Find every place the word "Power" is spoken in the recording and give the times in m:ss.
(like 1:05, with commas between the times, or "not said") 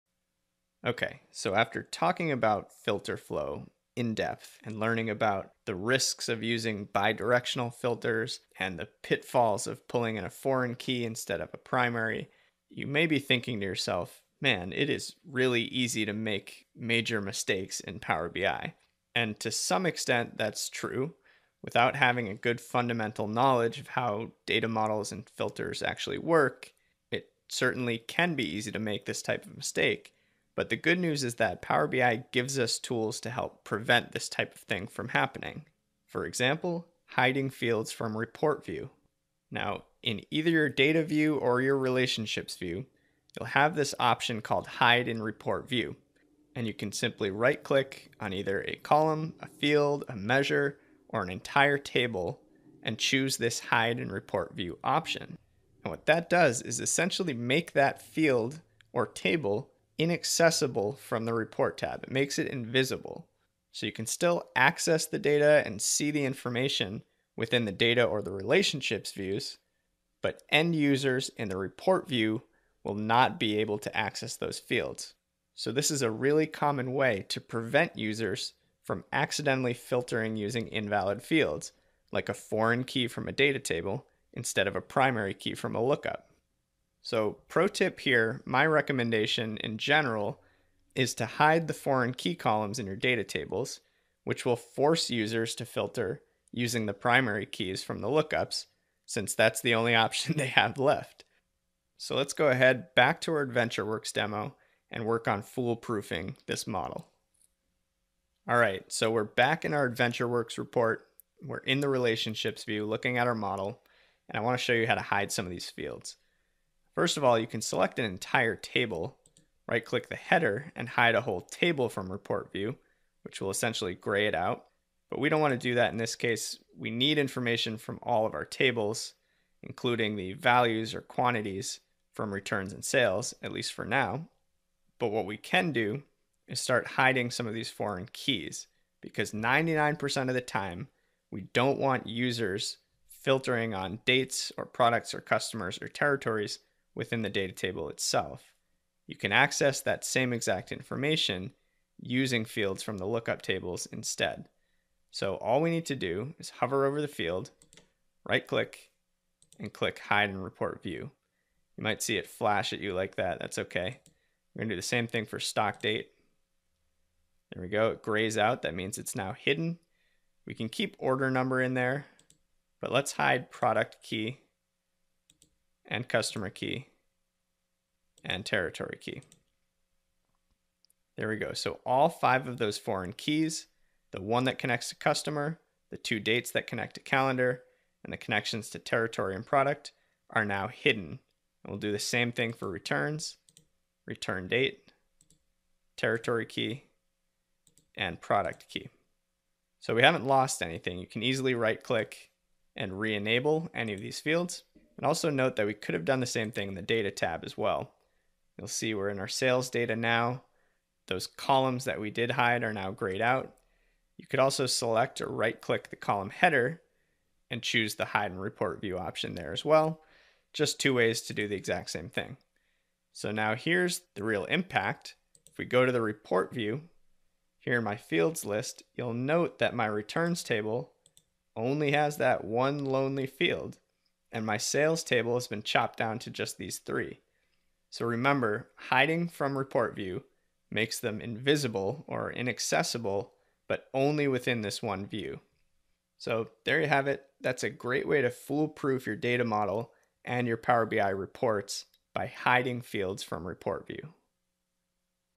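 0:17, 0:31, 4:10.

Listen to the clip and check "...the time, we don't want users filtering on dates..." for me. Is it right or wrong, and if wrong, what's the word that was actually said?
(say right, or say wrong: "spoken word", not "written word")
right.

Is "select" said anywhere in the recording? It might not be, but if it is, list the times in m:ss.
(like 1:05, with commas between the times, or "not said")
1:57, 3:34.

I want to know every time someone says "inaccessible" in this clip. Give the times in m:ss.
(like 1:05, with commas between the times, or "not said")
1:00, 4:02.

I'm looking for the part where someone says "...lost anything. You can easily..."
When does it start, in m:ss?
3:20.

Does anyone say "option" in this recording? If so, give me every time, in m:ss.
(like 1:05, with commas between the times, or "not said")
0:43, 0:54, 1:39, 3:38.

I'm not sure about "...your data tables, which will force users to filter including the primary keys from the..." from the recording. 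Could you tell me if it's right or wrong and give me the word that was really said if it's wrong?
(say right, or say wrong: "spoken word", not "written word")
wrong: "using", not "including".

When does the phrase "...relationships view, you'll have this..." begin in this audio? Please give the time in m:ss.
0:41.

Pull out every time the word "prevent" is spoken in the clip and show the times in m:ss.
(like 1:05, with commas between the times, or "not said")
0:33, 1:17.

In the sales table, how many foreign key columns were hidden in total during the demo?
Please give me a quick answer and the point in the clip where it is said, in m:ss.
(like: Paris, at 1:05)
5, at 3:02.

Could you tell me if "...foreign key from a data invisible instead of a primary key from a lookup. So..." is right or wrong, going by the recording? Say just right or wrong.
wrong.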